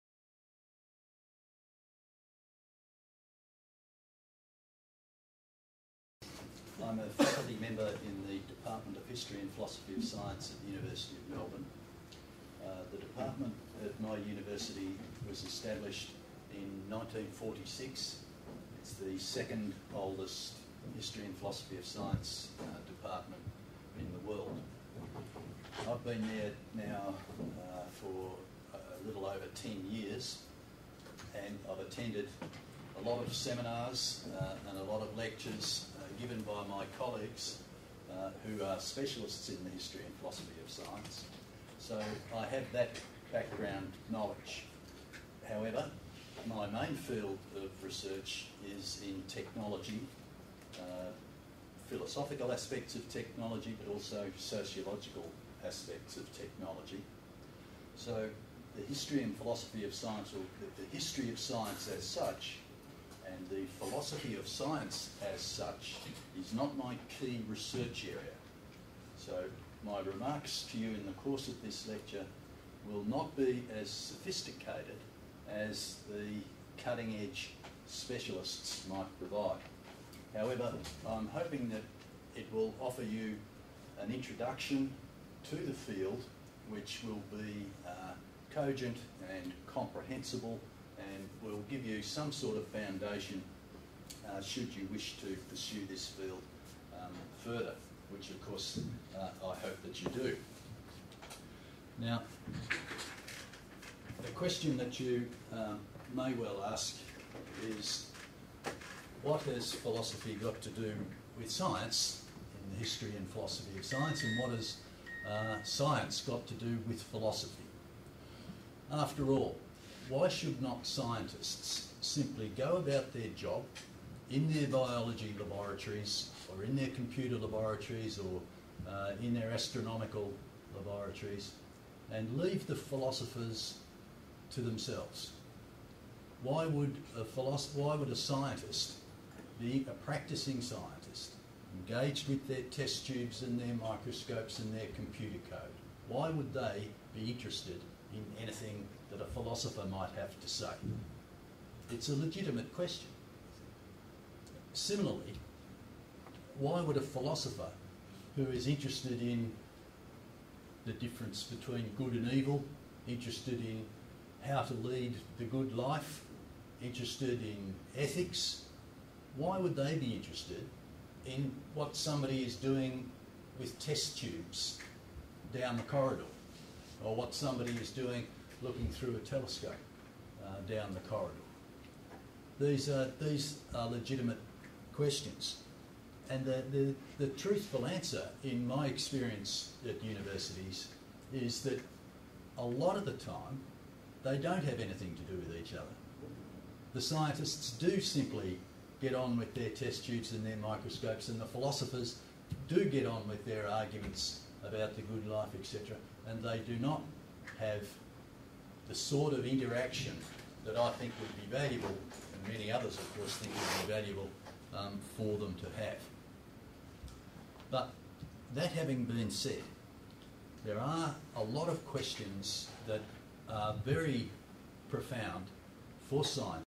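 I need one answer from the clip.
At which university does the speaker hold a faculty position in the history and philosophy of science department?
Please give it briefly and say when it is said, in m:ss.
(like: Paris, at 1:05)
University of Melbourne, at 0:10.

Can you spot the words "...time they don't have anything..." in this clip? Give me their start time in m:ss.
3:13.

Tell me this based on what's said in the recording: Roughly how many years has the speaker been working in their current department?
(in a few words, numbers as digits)
A little over 10.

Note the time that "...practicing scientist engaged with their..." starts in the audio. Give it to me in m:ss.
2:19.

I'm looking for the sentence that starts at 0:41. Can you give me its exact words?
So I have that background knowledge.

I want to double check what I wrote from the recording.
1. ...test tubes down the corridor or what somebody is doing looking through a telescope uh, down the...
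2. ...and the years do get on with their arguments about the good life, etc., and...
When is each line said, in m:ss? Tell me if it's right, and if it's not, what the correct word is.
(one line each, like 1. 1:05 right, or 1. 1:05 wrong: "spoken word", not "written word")
1. 2:53 right
2. 3:21 wrong: "philosophers", not "years".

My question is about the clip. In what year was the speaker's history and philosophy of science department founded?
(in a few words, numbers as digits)
1946.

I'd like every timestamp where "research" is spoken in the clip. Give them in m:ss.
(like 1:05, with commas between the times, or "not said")
0:47, 1:07.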